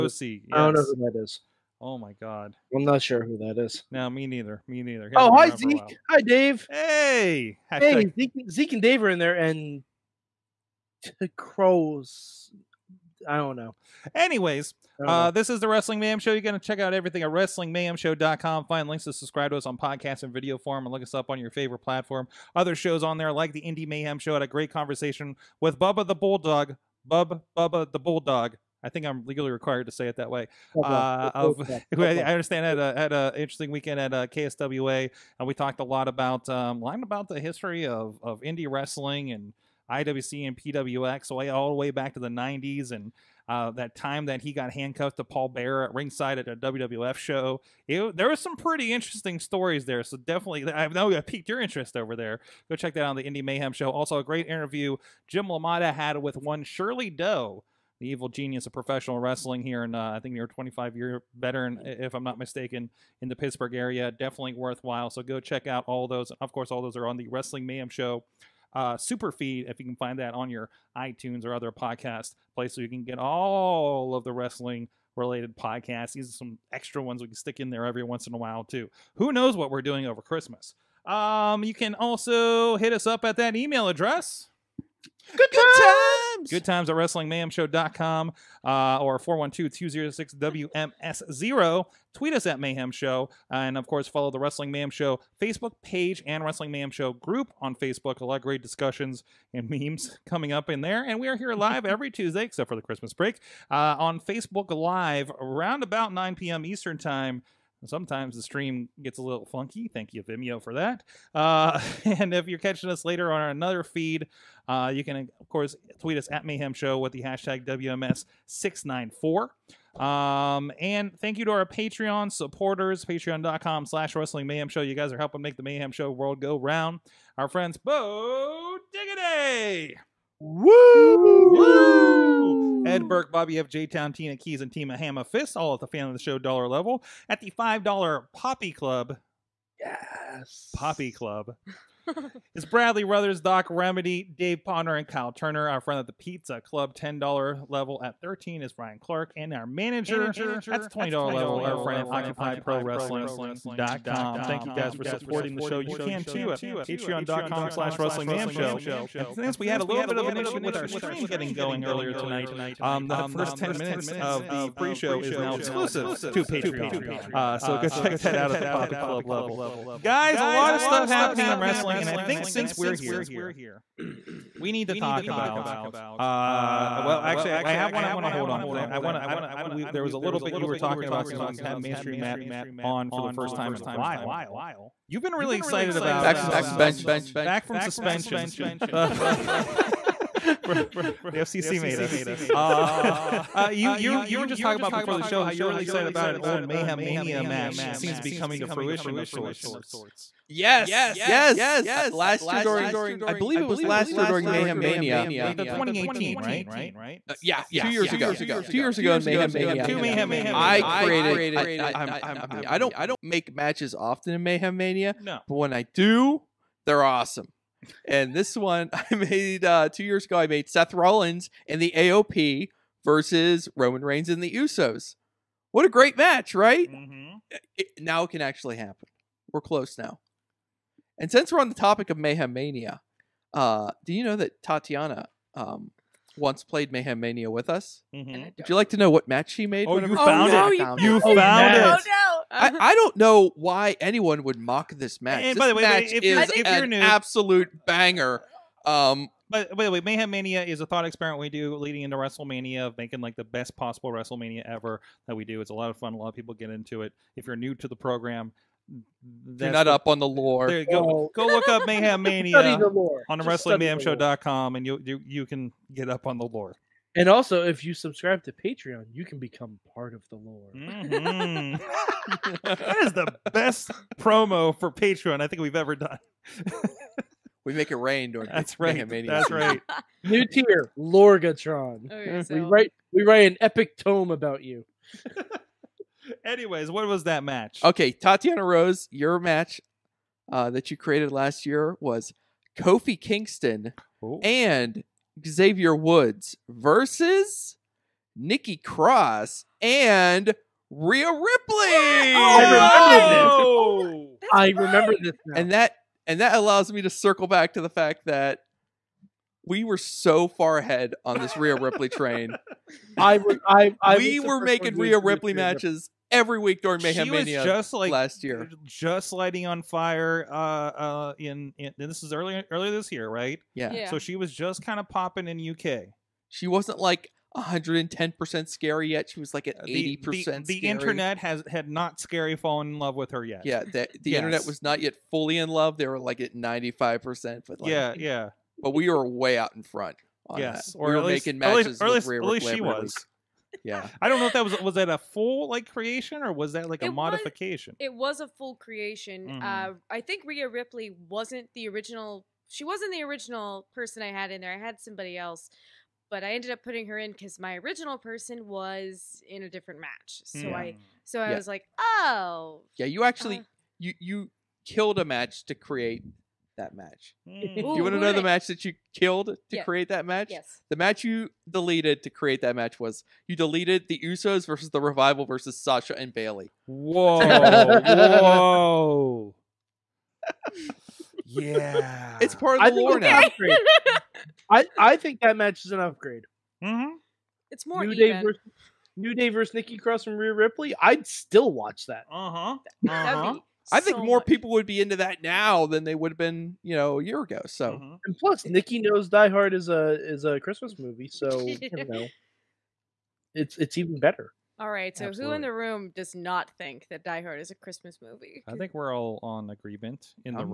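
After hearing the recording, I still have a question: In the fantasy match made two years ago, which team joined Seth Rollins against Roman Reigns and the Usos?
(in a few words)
AOP.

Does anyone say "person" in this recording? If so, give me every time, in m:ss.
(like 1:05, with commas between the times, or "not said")
5:53, 5:58.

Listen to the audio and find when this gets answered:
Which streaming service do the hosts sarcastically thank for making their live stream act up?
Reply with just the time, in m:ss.
1:50.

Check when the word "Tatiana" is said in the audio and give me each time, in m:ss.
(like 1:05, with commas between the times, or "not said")
3:54, 4:48.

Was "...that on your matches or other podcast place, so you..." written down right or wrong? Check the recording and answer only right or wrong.
wrong.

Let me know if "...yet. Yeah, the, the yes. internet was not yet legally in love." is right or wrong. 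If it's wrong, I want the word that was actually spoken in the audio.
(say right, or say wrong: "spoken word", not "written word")
wrong: "fully", not "legally".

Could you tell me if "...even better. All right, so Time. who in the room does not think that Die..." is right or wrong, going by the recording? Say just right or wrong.
wrong.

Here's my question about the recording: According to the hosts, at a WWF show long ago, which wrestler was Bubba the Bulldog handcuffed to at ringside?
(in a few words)
Paul Bearer.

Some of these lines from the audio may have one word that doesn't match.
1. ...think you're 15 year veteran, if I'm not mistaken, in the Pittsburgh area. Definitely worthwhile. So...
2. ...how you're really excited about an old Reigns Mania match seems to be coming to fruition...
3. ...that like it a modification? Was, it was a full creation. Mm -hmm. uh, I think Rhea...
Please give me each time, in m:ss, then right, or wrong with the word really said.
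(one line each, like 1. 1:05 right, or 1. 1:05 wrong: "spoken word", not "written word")
1. 1:00 wrong: "25", not "15"
2. 3:15 wrong: "Mayhem", not "Reigns"
3. 5:46 right.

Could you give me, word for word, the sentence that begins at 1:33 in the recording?
Uh, and, of course, follow the Wrestling Mayhem Show Facebook page and Wrestling Mayhem Show group on Facebook.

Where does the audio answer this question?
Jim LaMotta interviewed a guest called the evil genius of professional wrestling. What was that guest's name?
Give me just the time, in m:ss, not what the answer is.
0:56.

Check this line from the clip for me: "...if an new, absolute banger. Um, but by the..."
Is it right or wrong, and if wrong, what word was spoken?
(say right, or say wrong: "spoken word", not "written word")
right.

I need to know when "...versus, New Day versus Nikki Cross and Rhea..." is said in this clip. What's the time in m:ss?
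6:28.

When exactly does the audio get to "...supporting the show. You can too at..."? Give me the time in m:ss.
2:35.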